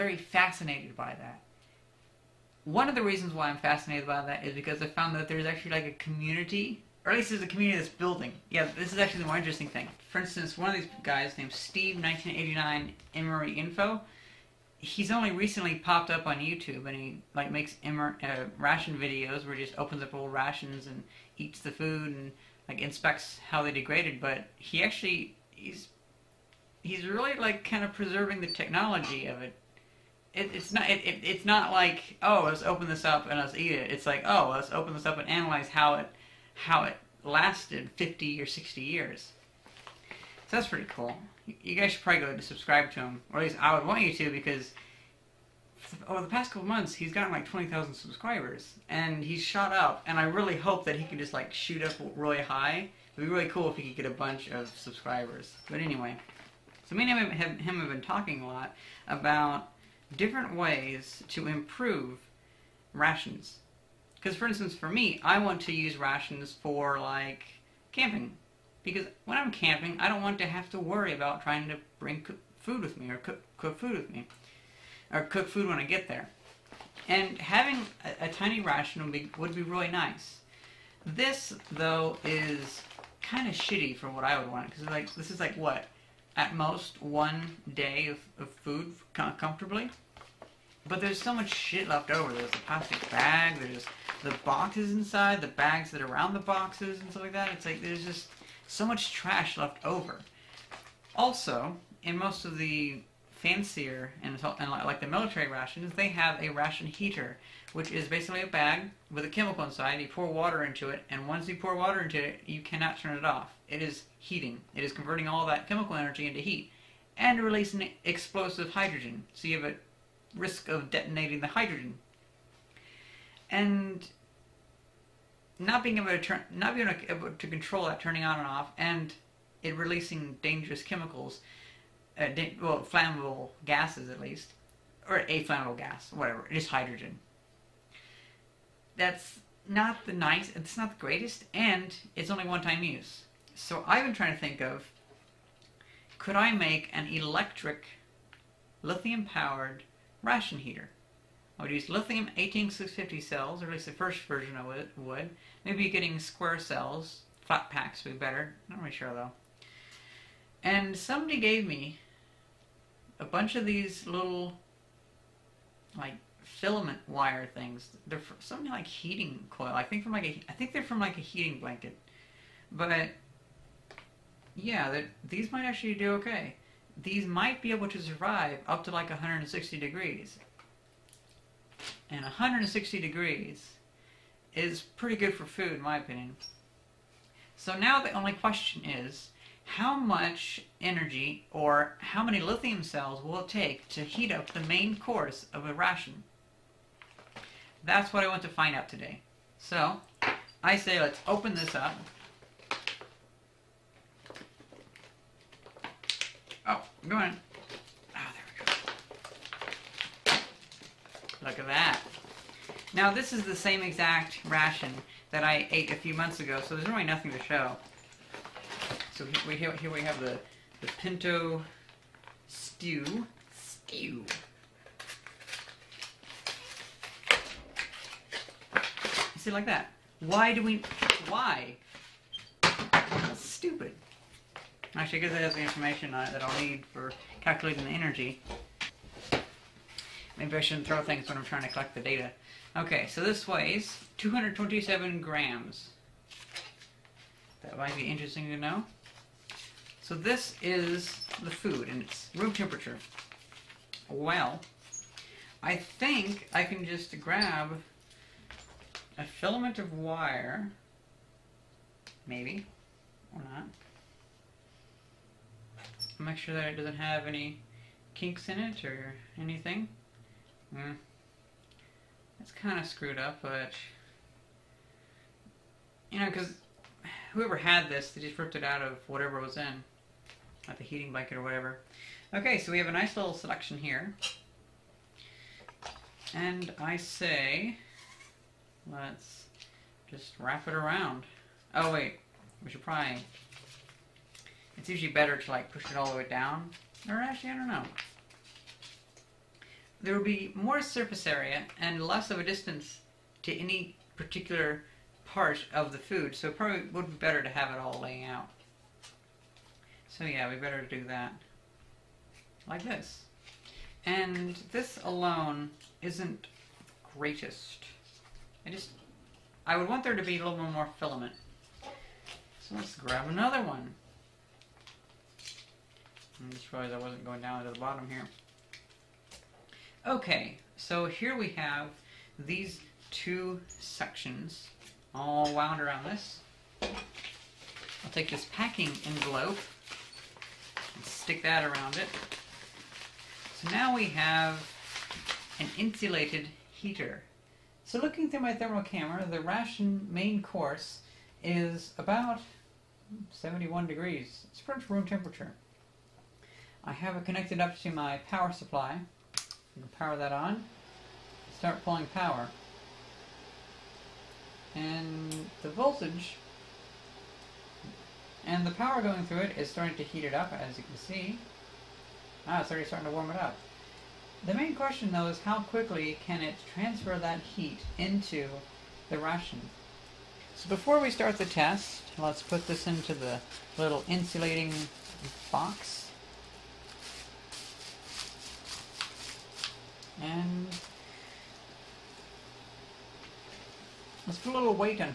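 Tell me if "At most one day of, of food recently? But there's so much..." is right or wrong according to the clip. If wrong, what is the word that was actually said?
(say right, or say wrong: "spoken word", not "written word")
wrong: "comfortably", not "recently".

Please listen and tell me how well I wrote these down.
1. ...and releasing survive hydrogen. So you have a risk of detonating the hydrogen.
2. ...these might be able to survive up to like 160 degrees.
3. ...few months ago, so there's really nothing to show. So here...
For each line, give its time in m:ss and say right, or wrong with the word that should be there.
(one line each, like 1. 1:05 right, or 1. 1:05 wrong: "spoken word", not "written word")
1. 1:57 wrong: "explosive", not "survive"
2. 2:57 right
3. 3:35 right.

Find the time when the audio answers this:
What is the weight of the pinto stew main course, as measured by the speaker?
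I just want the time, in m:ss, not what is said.
4:04.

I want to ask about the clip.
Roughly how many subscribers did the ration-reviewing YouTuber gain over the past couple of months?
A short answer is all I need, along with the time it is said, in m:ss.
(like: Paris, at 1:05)
20,000, at 0:47.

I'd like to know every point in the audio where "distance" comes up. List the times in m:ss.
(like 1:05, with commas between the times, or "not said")
5:02.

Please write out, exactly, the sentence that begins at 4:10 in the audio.
So this is the food, and it's room temperature.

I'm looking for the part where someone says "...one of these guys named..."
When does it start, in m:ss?
0:10.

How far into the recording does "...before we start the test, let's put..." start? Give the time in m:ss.
6:20.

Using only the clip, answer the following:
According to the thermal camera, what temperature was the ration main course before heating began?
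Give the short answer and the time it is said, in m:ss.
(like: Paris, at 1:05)
71 degrees, at 5:53.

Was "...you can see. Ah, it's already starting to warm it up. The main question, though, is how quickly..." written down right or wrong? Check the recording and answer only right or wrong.
right.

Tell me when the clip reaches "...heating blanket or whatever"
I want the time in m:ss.
4:40.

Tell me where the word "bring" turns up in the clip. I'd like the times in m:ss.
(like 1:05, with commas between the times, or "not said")
1:11.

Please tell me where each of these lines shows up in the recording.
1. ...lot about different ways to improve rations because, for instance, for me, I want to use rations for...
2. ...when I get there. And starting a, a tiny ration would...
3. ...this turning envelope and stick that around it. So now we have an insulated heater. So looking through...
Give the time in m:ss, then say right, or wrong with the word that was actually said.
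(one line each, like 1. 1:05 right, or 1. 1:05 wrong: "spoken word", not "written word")
1. 0:58 right
2. 1:15 wrong: "having", not "starting"
3. 5:38 wrong: "packing", not "turning".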